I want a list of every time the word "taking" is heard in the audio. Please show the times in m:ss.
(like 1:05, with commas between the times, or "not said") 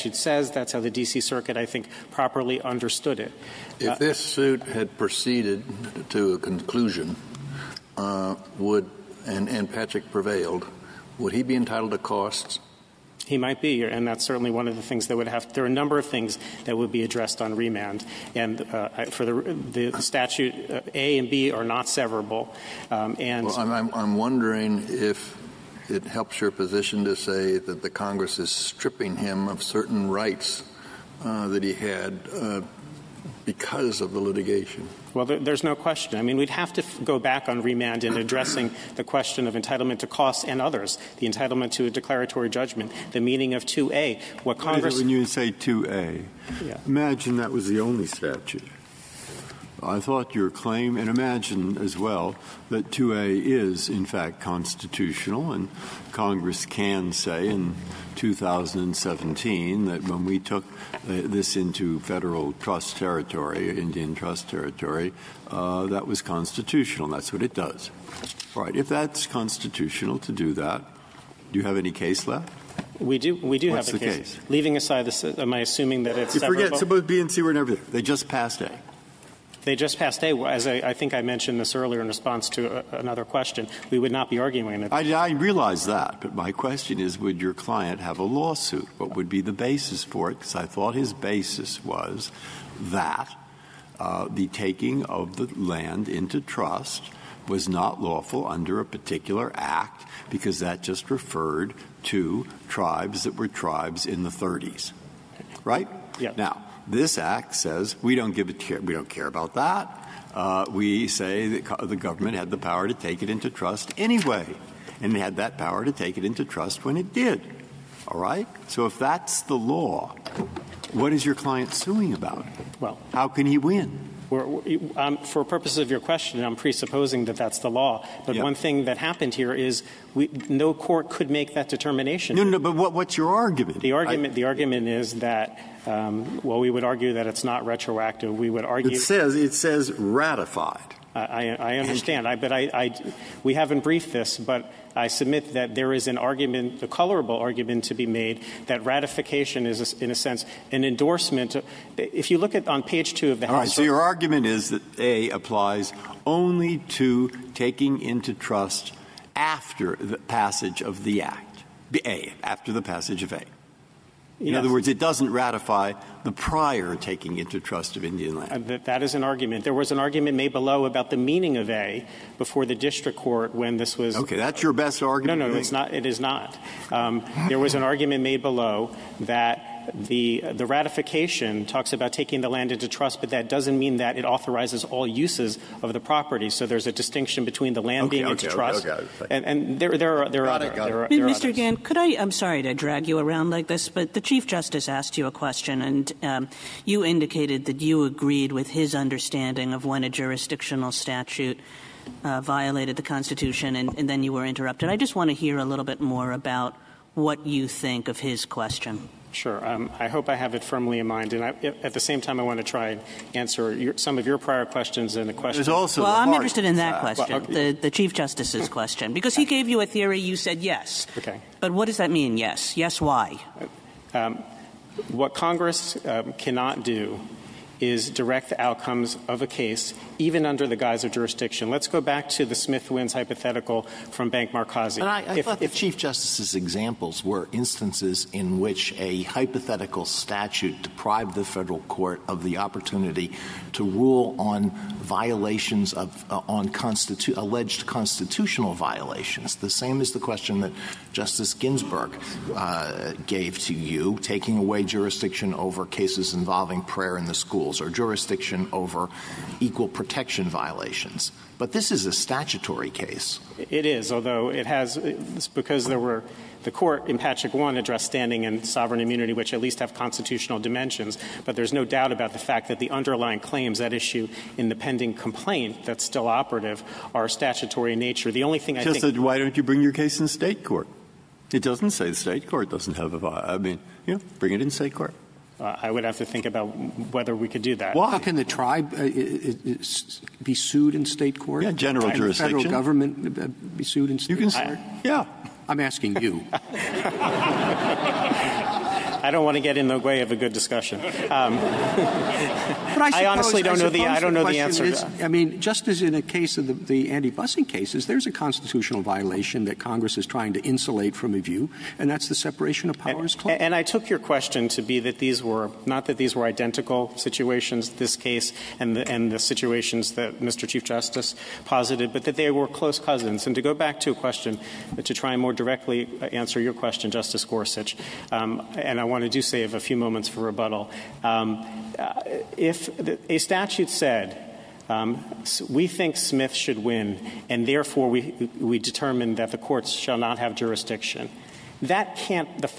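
1:34, 2:37, 2:46, 3:02, 4:14.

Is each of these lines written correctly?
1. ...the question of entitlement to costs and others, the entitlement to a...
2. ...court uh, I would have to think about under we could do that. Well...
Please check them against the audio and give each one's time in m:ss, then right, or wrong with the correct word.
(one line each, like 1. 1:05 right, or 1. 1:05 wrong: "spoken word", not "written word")
1. 0:38 right
2. 4:44 wrong: "whether", not "under".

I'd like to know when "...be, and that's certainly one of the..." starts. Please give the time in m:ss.
0:13.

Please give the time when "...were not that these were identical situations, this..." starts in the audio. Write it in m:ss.
5:15.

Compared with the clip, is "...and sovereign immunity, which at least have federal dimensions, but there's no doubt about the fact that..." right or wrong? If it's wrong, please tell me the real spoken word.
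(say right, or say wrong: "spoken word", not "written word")
wrong: "constitutional", not "federal".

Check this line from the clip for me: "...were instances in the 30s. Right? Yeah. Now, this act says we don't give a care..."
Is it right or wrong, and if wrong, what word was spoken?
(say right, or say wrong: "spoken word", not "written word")
wrong: "tribes", not "instances".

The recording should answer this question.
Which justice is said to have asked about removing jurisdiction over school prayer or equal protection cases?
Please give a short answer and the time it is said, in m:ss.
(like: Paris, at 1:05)
Justice Ginsburg, at 4:11.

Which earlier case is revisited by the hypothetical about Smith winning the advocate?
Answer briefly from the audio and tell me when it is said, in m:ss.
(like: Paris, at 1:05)
Bank Markazi, at 3:54.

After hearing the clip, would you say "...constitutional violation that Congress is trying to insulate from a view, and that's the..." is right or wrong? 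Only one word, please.
right.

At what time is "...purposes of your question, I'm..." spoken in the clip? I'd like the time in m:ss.
2:05.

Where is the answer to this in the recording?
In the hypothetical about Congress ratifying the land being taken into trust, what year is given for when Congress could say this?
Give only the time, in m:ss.
0:58.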